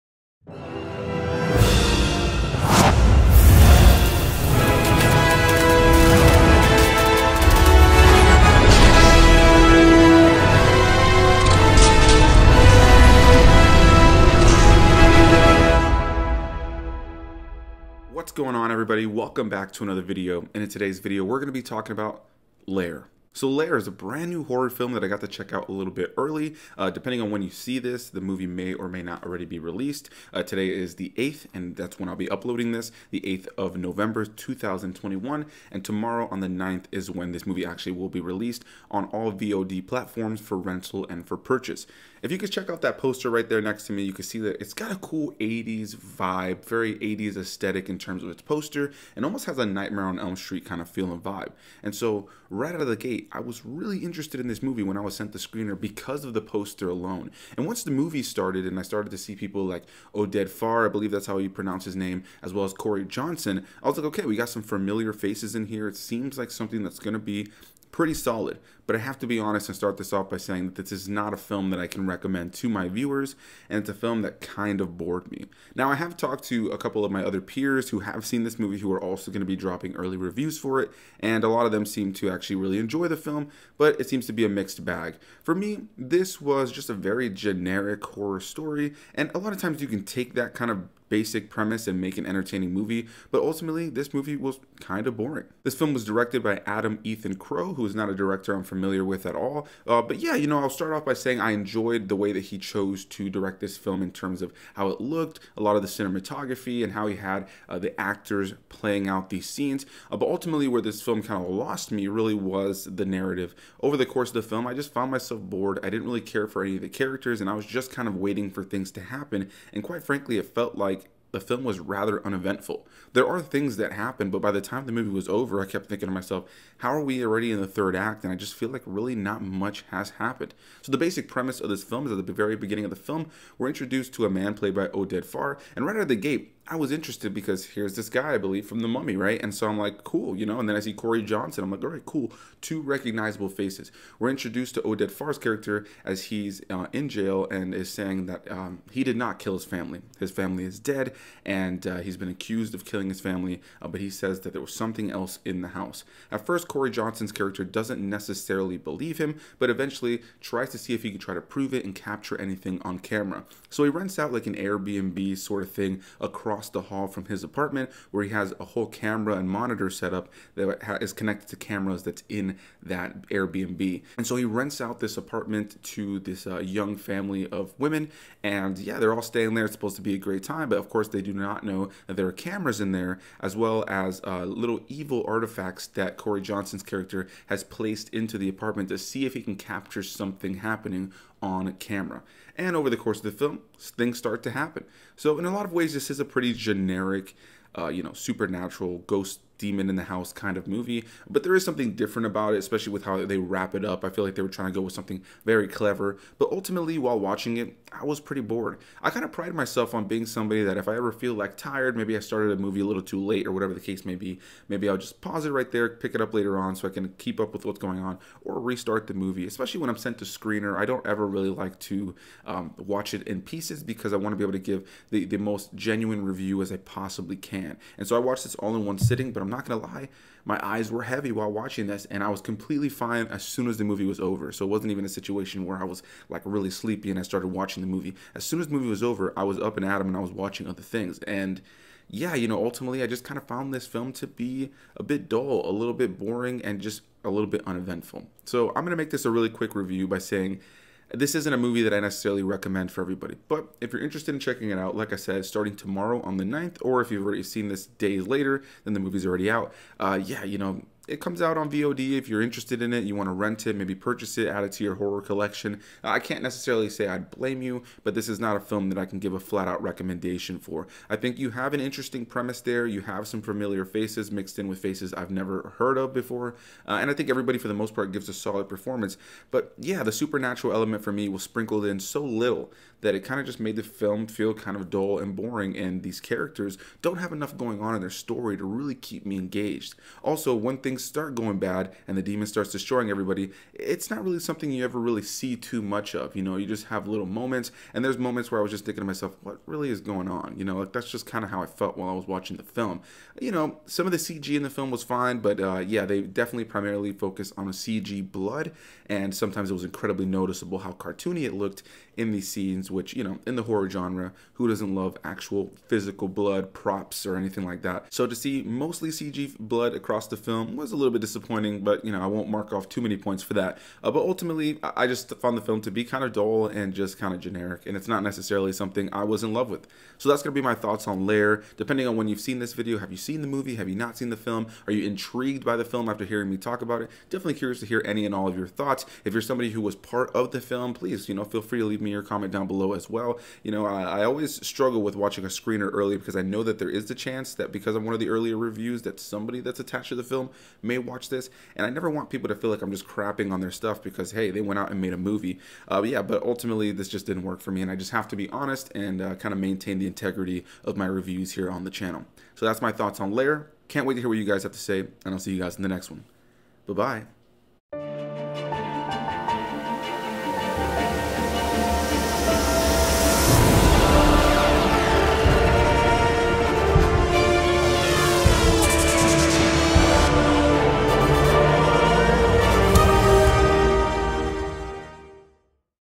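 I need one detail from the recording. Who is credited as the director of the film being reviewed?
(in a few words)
Adam Ethan Crow.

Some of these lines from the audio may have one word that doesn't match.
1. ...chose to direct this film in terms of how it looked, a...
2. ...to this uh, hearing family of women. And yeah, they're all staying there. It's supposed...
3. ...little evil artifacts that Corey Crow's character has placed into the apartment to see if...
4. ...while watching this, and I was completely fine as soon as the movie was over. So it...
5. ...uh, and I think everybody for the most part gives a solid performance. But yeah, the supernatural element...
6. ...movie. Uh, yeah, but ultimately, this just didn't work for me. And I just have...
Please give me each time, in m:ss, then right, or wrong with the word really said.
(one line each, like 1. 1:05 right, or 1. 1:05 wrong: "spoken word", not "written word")
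1. 1:42 right
2. 2:55 wrong: "young", not "hearing"
3. 3:04 wrong: "Johnson", not "Crow"
4. 3:51 right
5. 4:36 right
6. 5:55 right.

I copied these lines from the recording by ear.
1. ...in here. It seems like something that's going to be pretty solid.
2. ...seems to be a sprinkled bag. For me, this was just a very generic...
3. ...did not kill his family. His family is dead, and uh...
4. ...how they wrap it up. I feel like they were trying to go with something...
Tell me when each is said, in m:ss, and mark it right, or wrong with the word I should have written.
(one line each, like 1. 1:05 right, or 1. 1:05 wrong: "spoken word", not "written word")
1. 1:05 right
2. 1:24 wrong: "mixed", not "sprinkled"
3. 2:29 right
4. 3:23 right.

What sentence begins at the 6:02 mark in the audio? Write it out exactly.
So that's my thoughts on Lair.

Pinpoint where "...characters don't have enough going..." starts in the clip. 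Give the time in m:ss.
4:46.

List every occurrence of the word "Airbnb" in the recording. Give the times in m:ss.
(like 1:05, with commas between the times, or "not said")
2:44, 2:53.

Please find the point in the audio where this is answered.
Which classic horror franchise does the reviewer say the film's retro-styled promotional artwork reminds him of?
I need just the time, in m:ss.
0:49.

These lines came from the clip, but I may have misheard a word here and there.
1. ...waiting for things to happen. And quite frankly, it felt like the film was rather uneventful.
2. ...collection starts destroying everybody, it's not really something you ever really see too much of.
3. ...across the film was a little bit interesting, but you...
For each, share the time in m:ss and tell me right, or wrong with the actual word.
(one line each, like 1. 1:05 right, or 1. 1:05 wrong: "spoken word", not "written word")
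1. 1:58 right
2. 4:52 wrong: "demon", not "collection"
3. 5:19 wrong: "disappointing", not "interesting".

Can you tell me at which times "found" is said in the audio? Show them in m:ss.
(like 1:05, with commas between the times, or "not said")
1:54, 4:03, 5:25.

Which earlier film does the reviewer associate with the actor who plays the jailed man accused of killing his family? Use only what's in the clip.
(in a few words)
The Mummy.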